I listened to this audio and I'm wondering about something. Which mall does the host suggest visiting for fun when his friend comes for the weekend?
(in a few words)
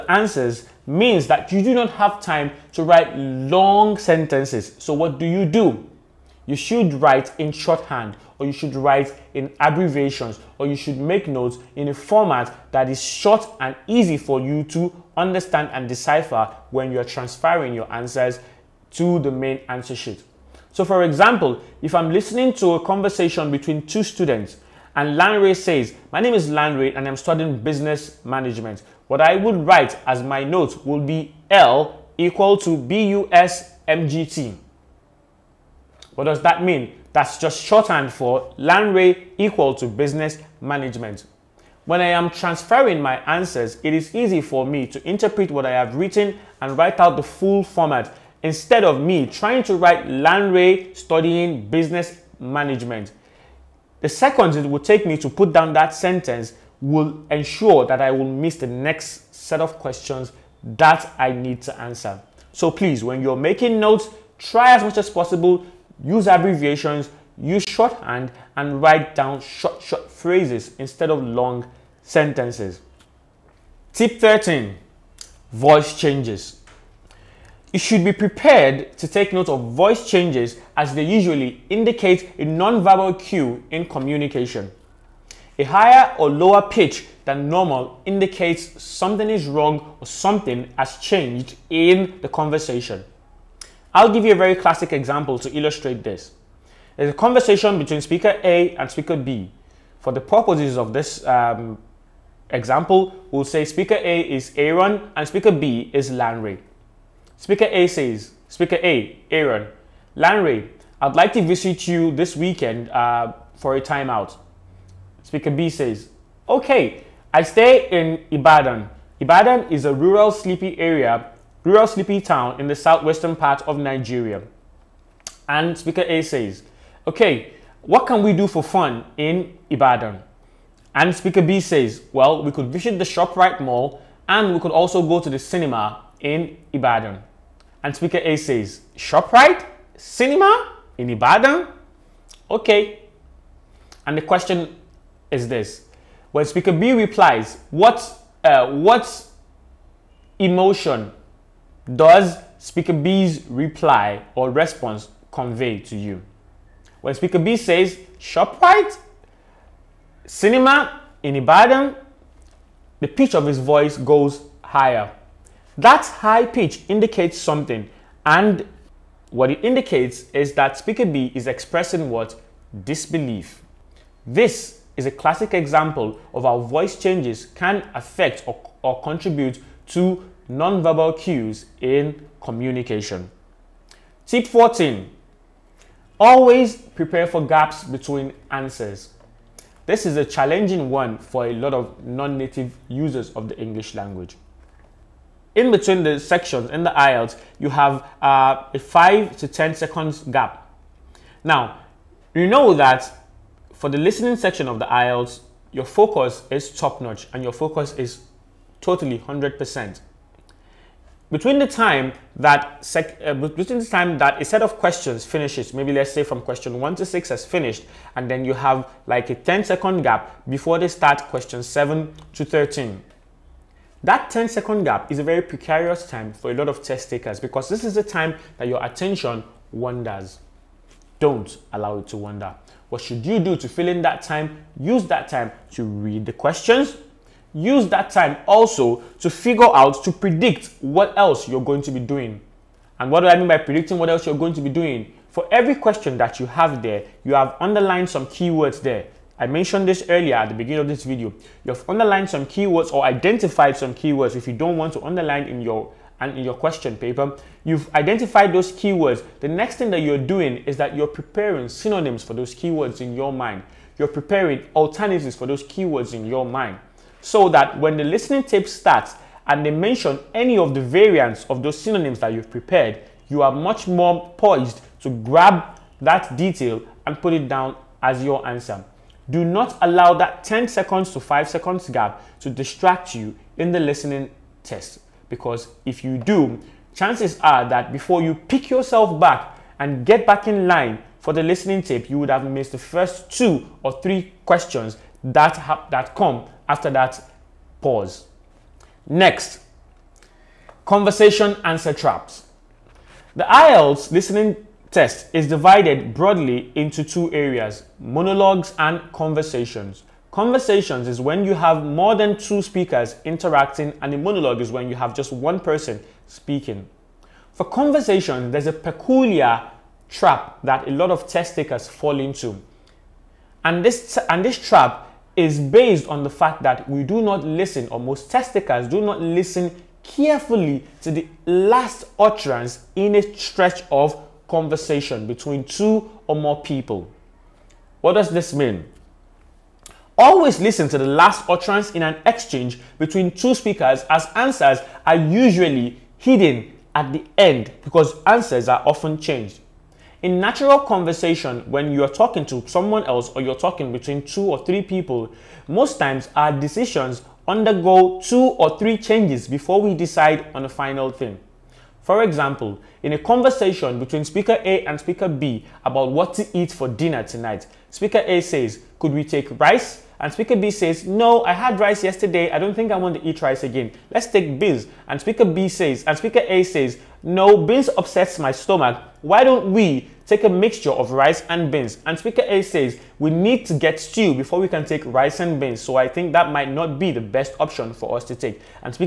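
ShopRite Mall.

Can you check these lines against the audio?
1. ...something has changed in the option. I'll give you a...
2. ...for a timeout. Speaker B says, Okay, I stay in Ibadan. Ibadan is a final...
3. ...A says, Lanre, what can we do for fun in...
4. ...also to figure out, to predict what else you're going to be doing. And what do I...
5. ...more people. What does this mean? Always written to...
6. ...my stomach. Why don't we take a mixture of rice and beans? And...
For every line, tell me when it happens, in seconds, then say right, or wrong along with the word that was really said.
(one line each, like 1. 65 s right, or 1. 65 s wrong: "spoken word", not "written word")
1. 90 s wrong: "conversation", not "option"
2. 113 s wrong: "rural", not "final"
3. 126 s wrong: "Okay", not "Lanre"
4. 238 s right
5. 336 s wrong: "listen", not "written"
6. 378 s right.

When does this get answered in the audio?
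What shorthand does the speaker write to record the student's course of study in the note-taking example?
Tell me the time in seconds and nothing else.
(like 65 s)
32 s.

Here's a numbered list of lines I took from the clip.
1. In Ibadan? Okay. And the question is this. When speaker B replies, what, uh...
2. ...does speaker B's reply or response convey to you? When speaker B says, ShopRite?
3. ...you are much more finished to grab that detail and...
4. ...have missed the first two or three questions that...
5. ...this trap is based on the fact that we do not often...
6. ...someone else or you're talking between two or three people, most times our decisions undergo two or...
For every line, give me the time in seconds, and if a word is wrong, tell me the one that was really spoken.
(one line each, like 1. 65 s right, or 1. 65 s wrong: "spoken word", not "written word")
1. 140 s right
2. 151 s right
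3. 273 s wrong: "poised", not "finished"
4. 292 s right
5. 324 s wrong: "listen", not "often"
6. 352 s right.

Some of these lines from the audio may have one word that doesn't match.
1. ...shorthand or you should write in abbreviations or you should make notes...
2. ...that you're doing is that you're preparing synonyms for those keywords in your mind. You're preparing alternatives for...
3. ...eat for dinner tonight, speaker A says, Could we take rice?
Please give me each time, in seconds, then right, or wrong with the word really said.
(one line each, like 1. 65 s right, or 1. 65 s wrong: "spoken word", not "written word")
1. 7 s right
2. 259 s right
3. 366 s right.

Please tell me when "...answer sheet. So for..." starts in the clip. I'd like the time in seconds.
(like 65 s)
19 s.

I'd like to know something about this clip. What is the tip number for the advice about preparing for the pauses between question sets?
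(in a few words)
14.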